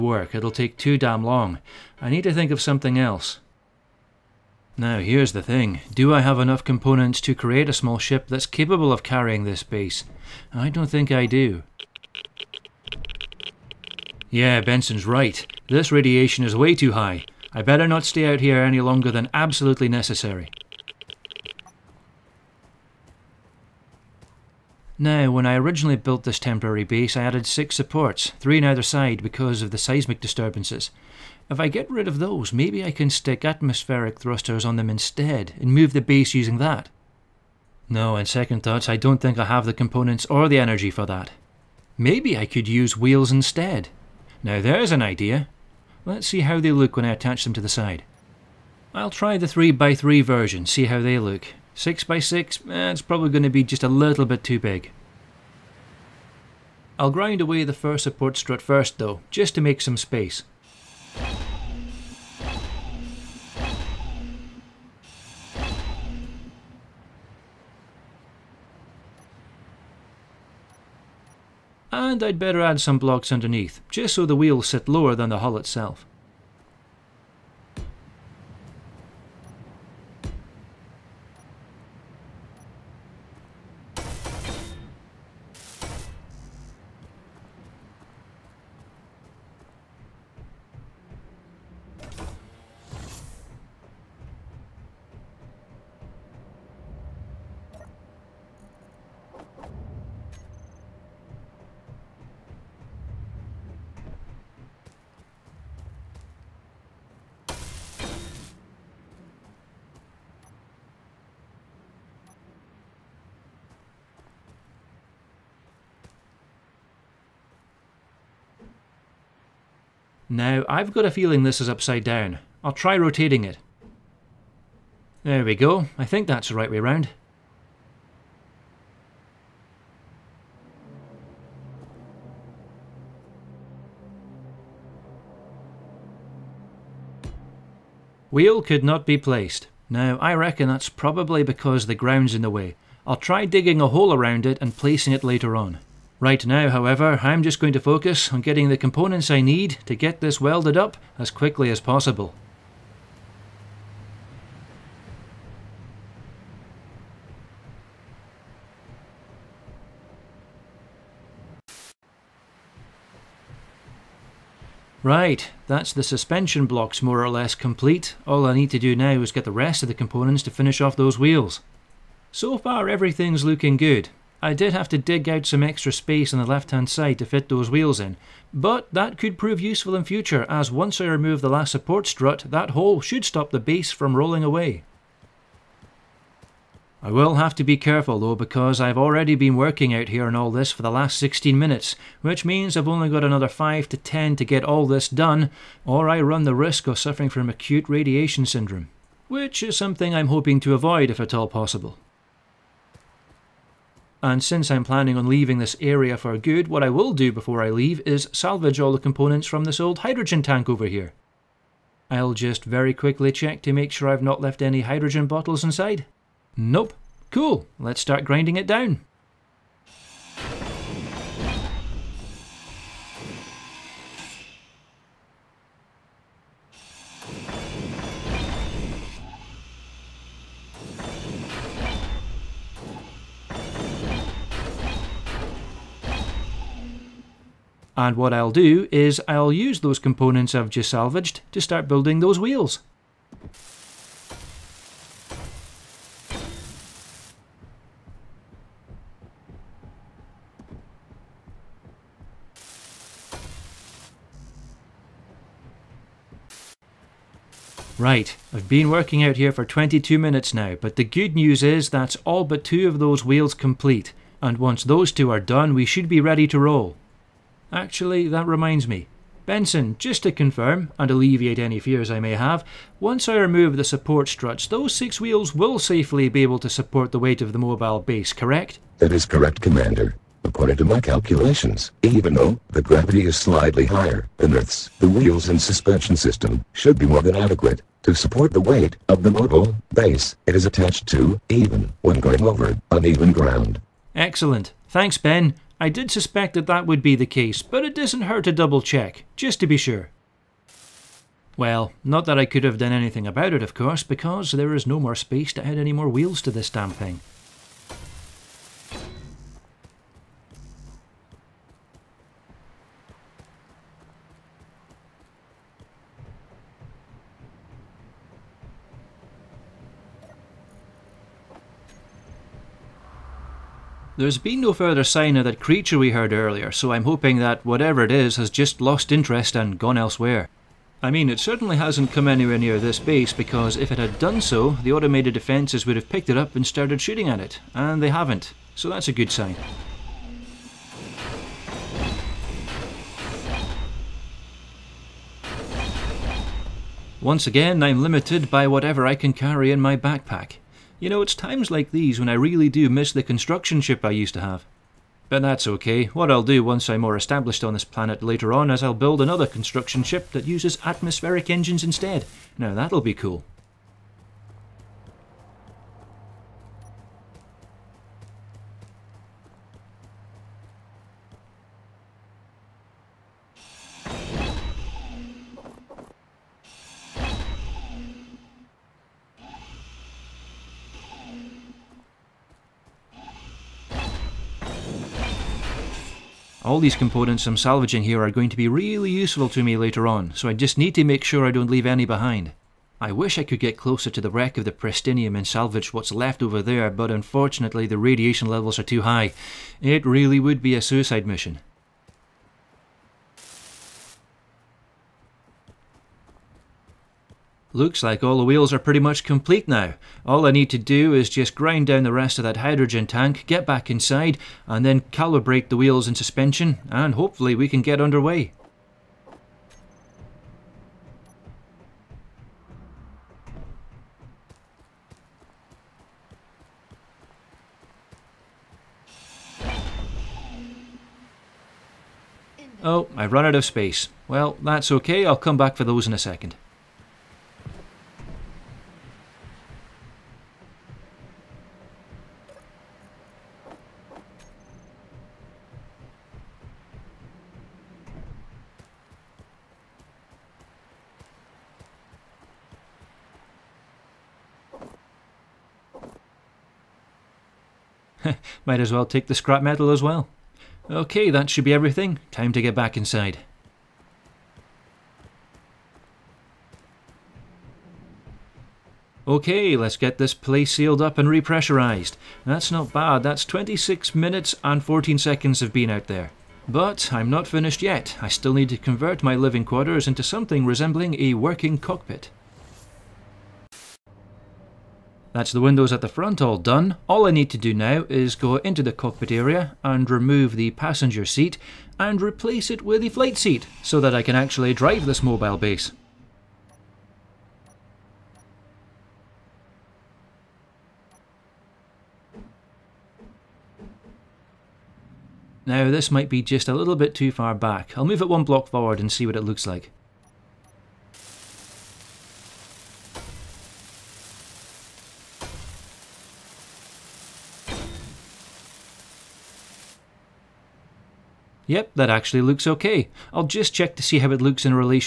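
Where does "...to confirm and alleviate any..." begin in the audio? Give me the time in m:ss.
4:30.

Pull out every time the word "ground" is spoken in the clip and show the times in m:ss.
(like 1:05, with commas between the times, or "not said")
2:21, 4:53.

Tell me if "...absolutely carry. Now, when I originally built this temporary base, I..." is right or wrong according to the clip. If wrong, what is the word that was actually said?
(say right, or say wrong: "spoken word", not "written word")
wrong: "necessary", not "carry".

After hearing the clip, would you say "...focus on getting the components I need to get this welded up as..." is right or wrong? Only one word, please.
right.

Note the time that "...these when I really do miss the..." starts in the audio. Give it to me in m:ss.
5:51.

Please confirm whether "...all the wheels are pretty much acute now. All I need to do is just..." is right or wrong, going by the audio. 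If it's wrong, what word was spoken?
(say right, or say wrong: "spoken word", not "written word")
wrong: "complete", not "acute".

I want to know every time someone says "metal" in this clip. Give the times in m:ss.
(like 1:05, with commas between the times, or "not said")
7:39.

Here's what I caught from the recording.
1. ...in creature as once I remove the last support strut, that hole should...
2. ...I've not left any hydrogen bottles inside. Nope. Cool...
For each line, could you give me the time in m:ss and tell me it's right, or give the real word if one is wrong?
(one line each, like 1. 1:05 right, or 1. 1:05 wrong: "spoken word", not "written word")
1. 2:59 wrong: "future", not "creature"
2. 3:34 right.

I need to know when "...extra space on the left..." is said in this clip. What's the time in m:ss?
2:55.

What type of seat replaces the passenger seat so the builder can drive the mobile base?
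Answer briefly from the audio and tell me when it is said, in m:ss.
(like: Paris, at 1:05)
Flight seat, at 8:13.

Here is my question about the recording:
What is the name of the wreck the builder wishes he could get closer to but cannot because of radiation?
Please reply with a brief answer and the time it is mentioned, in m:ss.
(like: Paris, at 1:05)
Prestinium, at 6:34.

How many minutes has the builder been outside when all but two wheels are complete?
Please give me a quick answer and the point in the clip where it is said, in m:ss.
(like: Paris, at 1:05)
22, at 4:19.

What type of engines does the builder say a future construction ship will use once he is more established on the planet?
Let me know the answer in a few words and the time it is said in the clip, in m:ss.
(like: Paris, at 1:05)
Atmospheric engines, at 6:00.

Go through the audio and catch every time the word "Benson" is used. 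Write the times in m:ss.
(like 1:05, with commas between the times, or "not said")
0:14, 4:29.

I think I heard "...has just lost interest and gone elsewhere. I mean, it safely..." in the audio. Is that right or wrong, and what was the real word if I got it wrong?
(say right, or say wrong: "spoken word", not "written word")
wrong: "certainly", not "safely".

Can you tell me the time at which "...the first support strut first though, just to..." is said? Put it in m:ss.
0:57.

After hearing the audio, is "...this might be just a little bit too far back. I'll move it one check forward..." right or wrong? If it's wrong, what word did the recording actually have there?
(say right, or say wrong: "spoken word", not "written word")
wrong: "block", not "check".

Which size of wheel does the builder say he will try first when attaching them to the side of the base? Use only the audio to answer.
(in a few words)
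3x3.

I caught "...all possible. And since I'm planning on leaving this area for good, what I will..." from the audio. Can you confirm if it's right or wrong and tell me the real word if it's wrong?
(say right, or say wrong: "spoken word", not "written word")
right.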